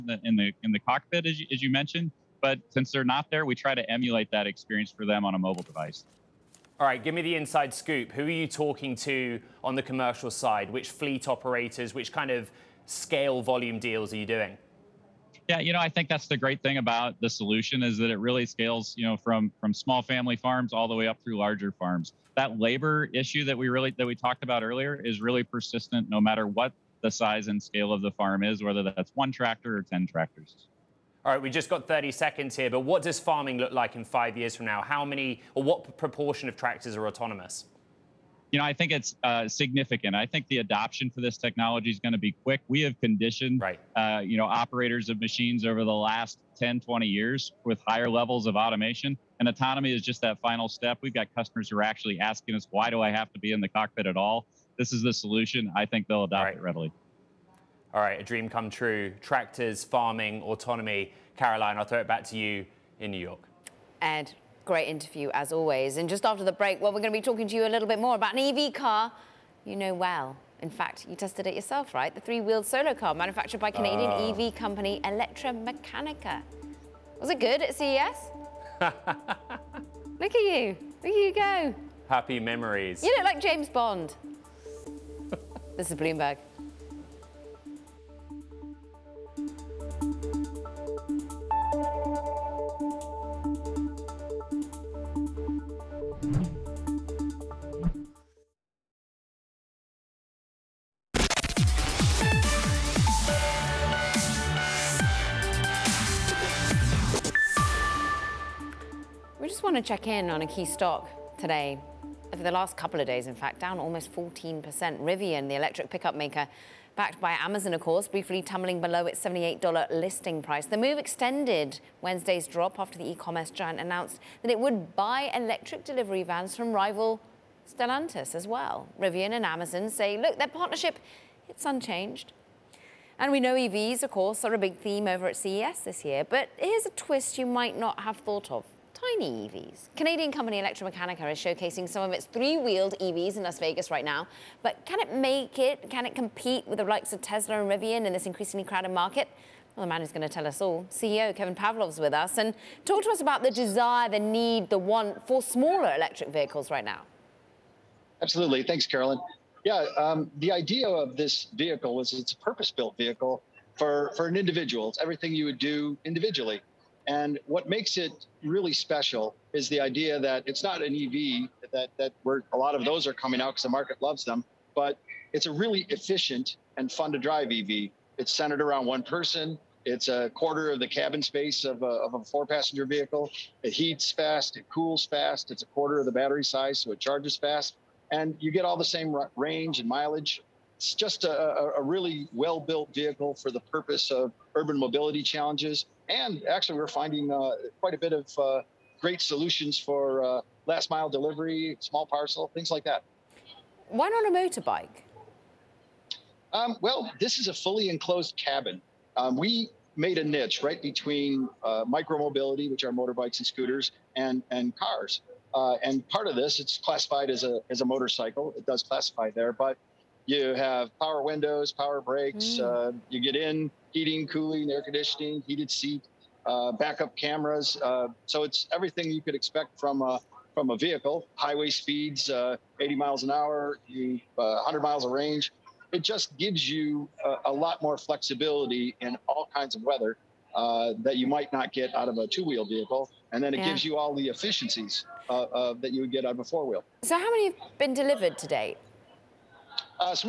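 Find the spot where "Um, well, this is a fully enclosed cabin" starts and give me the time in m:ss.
3:26.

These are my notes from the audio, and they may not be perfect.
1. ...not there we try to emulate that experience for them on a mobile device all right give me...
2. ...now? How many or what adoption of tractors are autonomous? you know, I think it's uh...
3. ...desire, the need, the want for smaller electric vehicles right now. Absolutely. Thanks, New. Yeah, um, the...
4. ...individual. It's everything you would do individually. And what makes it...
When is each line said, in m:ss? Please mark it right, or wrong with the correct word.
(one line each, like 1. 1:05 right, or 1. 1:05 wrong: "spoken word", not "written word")
1. 0:03 right
2. 0:34 wrong: "proportion", not "adoption"
3. 2:33 wrong: "Carolyn", not "New"
4. 2:44 right.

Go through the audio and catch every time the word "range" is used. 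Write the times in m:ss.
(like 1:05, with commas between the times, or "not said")
3:09, 3:55.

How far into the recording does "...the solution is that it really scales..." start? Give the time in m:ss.
0:17.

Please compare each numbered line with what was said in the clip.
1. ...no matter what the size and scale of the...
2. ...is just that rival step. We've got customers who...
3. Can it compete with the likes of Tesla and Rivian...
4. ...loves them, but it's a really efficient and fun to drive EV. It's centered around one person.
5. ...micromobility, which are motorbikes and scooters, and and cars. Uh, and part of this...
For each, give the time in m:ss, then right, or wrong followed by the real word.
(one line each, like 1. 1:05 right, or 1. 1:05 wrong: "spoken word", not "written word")
1. 0:26 right
2. 0:49 wrong: "final", not "rival"
3. 2:25 right
4. 2:54 right
5. 3:31 right.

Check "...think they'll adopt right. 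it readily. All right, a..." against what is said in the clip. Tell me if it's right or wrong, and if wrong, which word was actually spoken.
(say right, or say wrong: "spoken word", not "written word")
right.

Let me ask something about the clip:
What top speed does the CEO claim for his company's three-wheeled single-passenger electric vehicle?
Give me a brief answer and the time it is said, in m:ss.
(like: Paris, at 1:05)
80 miles an hour, at 3:52.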